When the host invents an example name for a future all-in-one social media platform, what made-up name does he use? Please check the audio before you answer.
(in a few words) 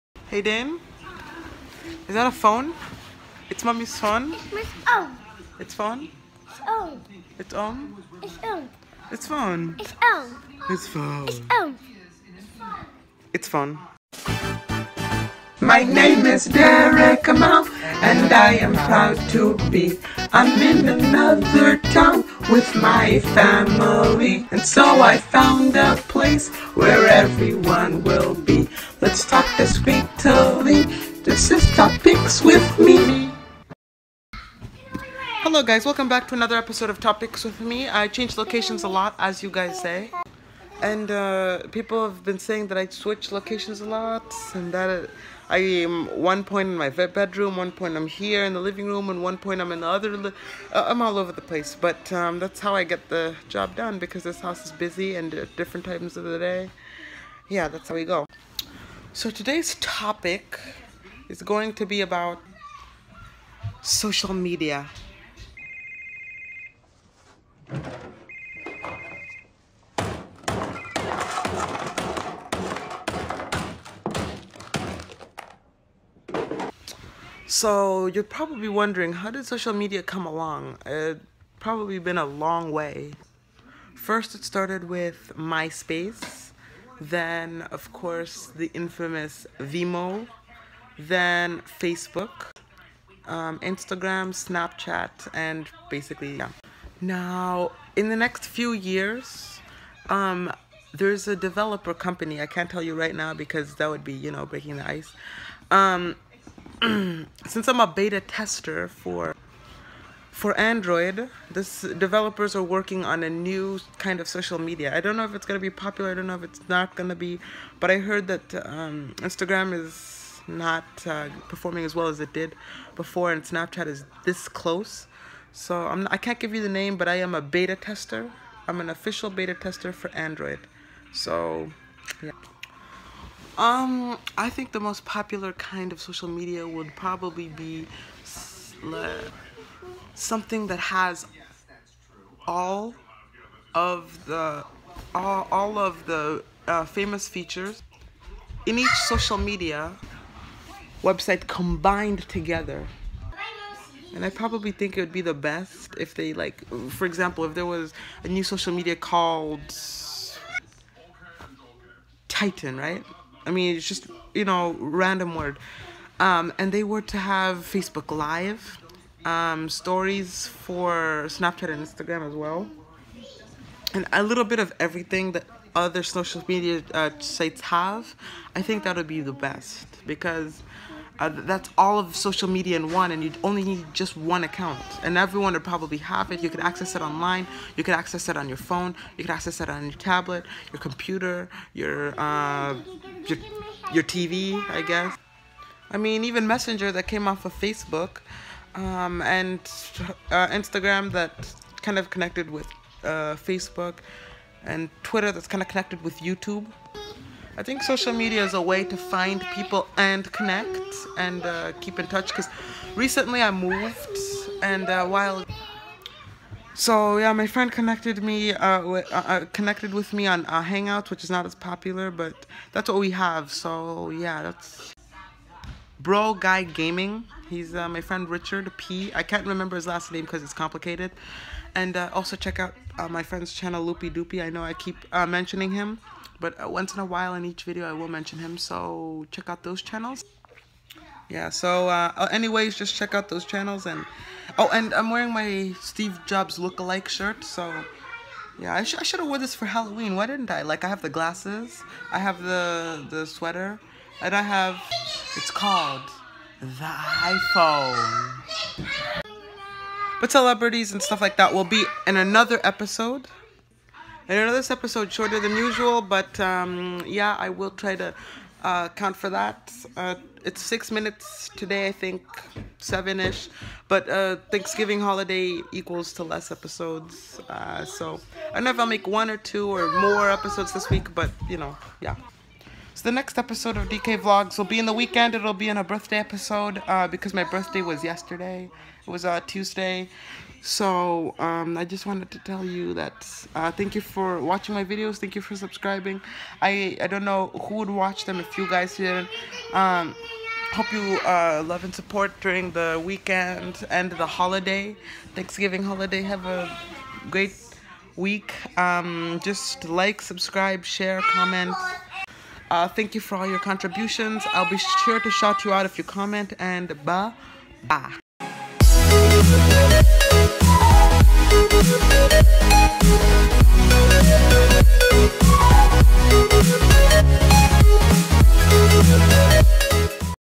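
Titan.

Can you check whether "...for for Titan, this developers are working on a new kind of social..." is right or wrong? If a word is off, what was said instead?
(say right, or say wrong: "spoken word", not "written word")
wrong: "Android", not "Titan".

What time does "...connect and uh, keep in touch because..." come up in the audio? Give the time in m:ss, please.
3:30.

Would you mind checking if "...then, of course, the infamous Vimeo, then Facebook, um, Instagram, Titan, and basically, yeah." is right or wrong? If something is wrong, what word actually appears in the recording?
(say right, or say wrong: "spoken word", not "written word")
wrong: "Snapchat", not "Titan".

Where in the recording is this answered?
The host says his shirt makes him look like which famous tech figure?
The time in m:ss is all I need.
4:05.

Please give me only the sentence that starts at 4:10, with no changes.
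Like, I have the glasses, I have the the sweater, and I have it's called the iPhone.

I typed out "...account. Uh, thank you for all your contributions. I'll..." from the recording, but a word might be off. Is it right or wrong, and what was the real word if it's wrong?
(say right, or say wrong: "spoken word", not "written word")
wrong: "comment", not "account".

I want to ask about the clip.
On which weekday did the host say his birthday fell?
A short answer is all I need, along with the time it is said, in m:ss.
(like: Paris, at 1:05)
Tuesday, at 4:49.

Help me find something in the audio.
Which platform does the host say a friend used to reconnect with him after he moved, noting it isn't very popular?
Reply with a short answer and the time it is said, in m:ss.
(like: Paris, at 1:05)
Hangout, at 3:40.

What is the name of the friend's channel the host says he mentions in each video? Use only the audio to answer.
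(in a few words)
Loopy Doopy.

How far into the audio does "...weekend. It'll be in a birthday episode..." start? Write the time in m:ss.
4:44.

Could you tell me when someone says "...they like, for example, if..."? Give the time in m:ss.
2:36.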